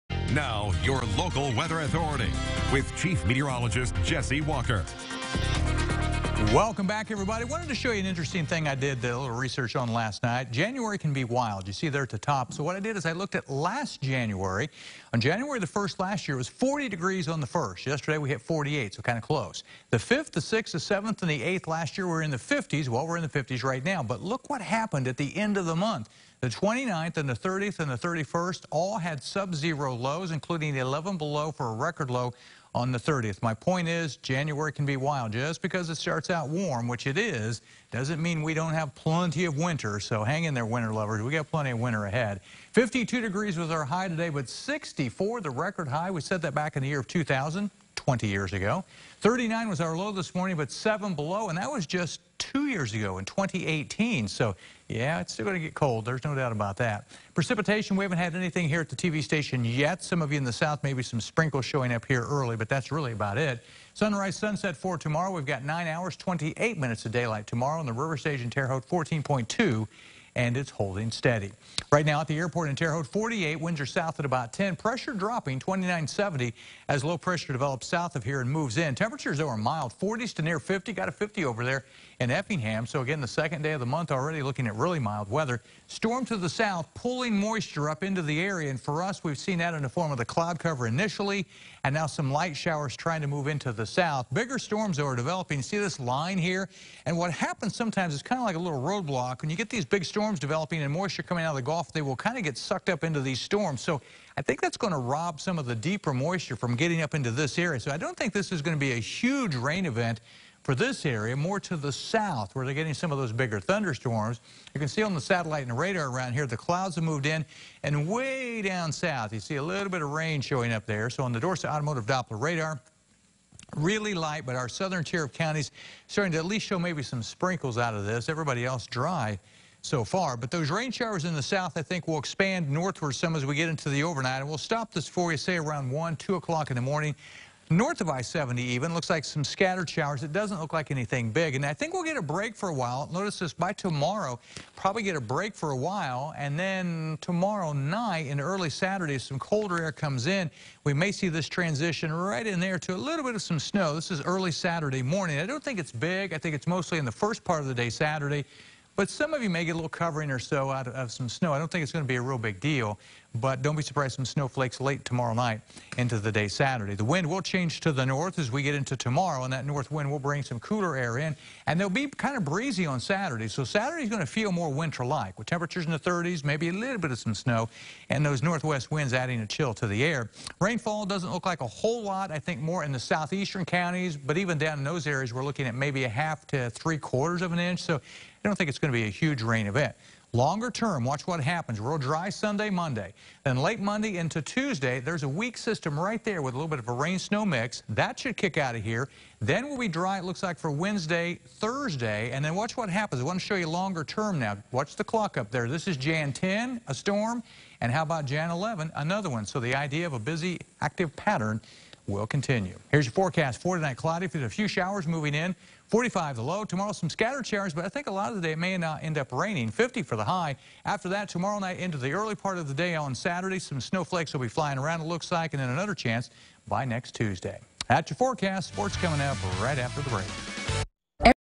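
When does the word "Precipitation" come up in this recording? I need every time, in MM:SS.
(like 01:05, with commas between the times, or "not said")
00:57.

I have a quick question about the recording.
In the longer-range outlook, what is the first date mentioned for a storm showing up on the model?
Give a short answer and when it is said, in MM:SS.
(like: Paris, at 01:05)
Jan 10, at 03:25.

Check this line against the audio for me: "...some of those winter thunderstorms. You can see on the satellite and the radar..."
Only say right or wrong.
wrong.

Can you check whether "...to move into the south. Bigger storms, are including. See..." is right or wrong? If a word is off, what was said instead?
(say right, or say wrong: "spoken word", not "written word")
wrong: "developing", not "including".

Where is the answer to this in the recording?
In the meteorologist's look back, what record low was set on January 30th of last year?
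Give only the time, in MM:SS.
00:30.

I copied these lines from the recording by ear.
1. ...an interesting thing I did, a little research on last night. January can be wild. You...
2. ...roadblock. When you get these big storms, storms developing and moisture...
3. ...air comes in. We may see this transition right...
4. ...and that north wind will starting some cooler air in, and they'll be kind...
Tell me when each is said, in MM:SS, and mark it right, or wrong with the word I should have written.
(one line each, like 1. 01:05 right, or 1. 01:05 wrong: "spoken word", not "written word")
1. 00:08 right
2. 01:38 right
3. 02:29 right
4. 02:49 wrong: "bring", not "starting".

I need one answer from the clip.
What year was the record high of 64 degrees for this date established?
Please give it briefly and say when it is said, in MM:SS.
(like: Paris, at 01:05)
2000, at 00:47.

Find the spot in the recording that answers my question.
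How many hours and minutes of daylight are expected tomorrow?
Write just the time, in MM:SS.
01:05.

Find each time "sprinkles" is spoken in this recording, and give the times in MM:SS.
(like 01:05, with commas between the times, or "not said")
01:01, 02:07.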